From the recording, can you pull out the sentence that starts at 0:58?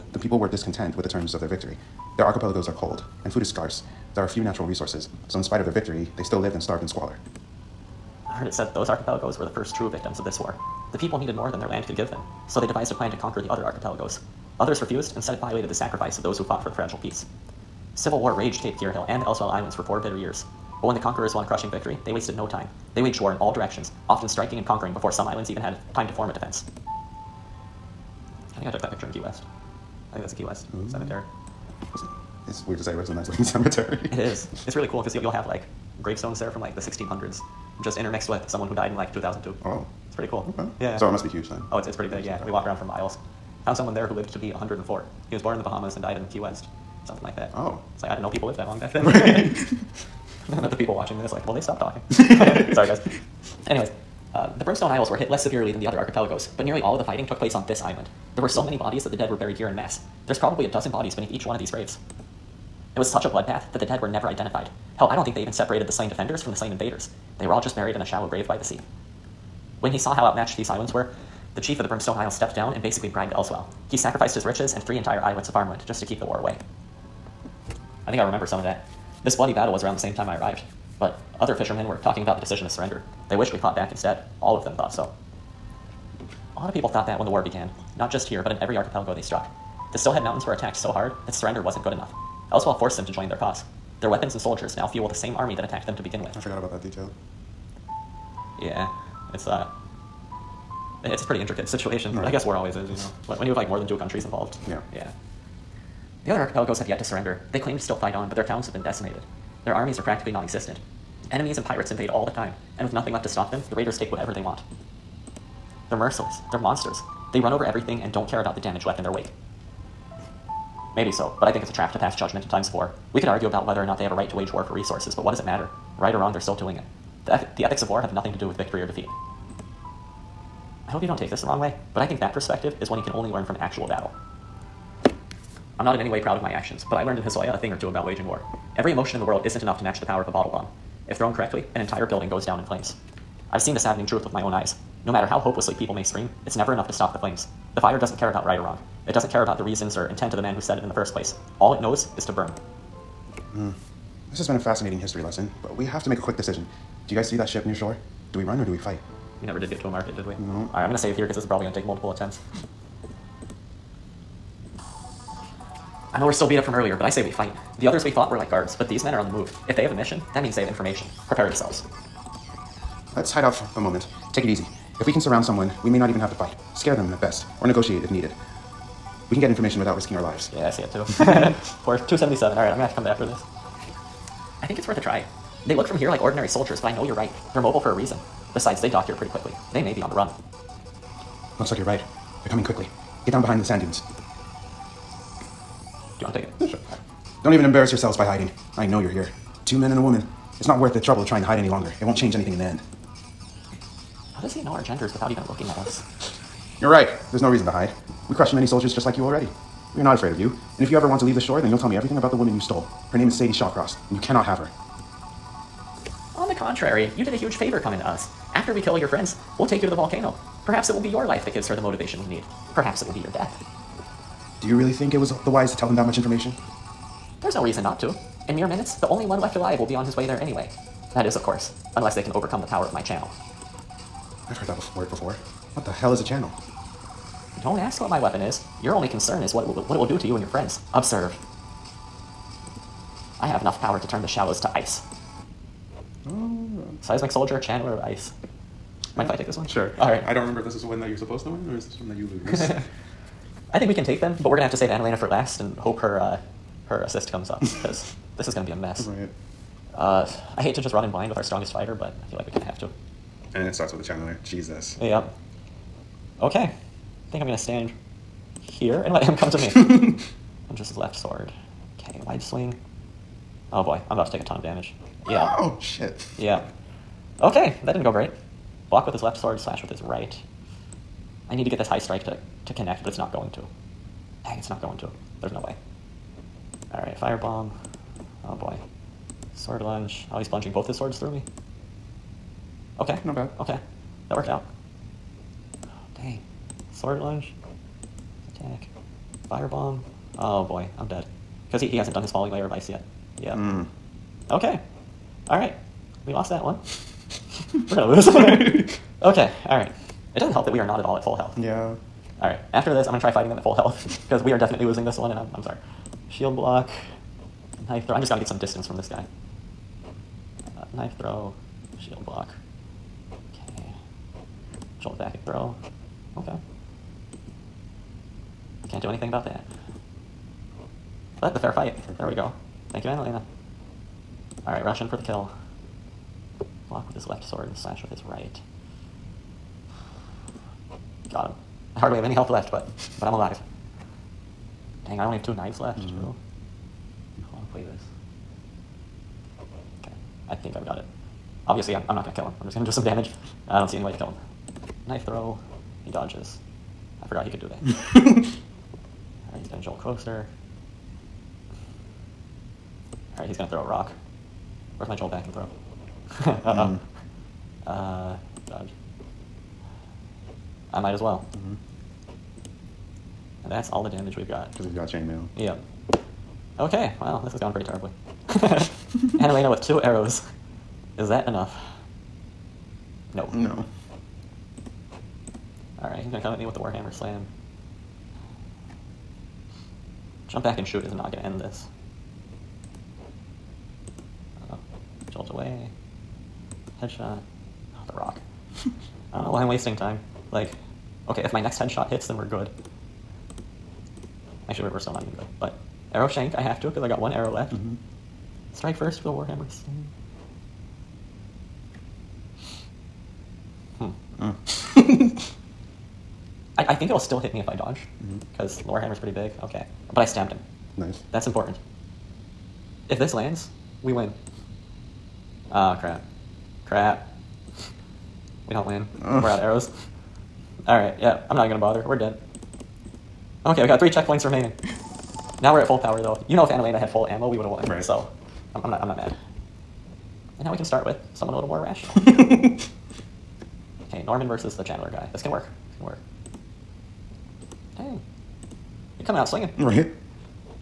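There were so many bodies that the dead were buried here in mass.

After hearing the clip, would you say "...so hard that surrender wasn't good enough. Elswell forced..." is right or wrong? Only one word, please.
right.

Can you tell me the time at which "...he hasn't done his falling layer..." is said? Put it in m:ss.
5:01.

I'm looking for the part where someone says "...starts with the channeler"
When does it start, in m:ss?
4:23.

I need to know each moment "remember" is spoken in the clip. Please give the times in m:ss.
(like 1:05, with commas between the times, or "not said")
1:18, 4:10.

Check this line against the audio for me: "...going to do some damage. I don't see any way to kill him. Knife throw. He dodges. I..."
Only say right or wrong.
right.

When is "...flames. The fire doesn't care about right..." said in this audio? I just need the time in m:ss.
2:27.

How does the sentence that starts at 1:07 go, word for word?
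They were all just buried in a shallow grave by the sea.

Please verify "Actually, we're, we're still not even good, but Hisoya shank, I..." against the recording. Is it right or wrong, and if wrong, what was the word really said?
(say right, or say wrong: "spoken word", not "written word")
wrong: "Arrow", not "Hisoya".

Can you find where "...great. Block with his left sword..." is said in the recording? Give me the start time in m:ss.
4:38.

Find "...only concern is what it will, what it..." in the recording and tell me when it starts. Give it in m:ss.
3:58.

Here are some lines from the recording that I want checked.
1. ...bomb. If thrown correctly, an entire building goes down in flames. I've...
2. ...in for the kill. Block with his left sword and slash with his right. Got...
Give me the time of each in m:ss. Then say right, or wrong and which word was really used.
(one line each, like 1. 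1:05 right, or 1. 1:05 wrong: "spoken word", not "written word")
1. 2:20 right
2. 5:35 right.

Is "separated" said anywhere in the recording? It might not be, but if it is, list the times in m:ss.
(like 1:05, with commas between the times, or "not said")
1:05.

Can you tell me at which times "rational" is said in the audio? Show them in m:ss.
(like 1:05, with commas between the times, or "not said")
7:21.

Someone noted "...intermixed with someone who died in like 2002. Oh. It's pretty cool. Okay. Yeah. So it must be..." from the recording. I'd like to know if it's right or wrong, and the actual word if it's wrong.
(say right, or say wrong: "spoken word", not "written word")
right.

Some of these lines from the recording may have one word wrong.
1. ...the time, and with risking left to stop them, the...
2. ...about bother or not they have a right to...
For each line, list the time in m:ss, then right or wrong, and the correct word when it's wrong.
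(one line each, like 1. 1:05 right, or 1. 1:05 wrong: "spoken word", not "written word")
1. 1:52 wrong: "nothing", not "risking"
2. 2:03 wrong: "whether", not "bother".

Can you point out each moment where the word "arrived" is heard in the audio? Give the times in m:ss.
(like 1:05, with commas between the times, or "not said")
1:20.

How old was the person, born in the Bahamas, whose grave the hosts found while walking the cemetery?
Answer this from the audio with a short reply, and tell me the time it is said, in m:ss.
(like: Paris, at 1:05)
104, at 0:44.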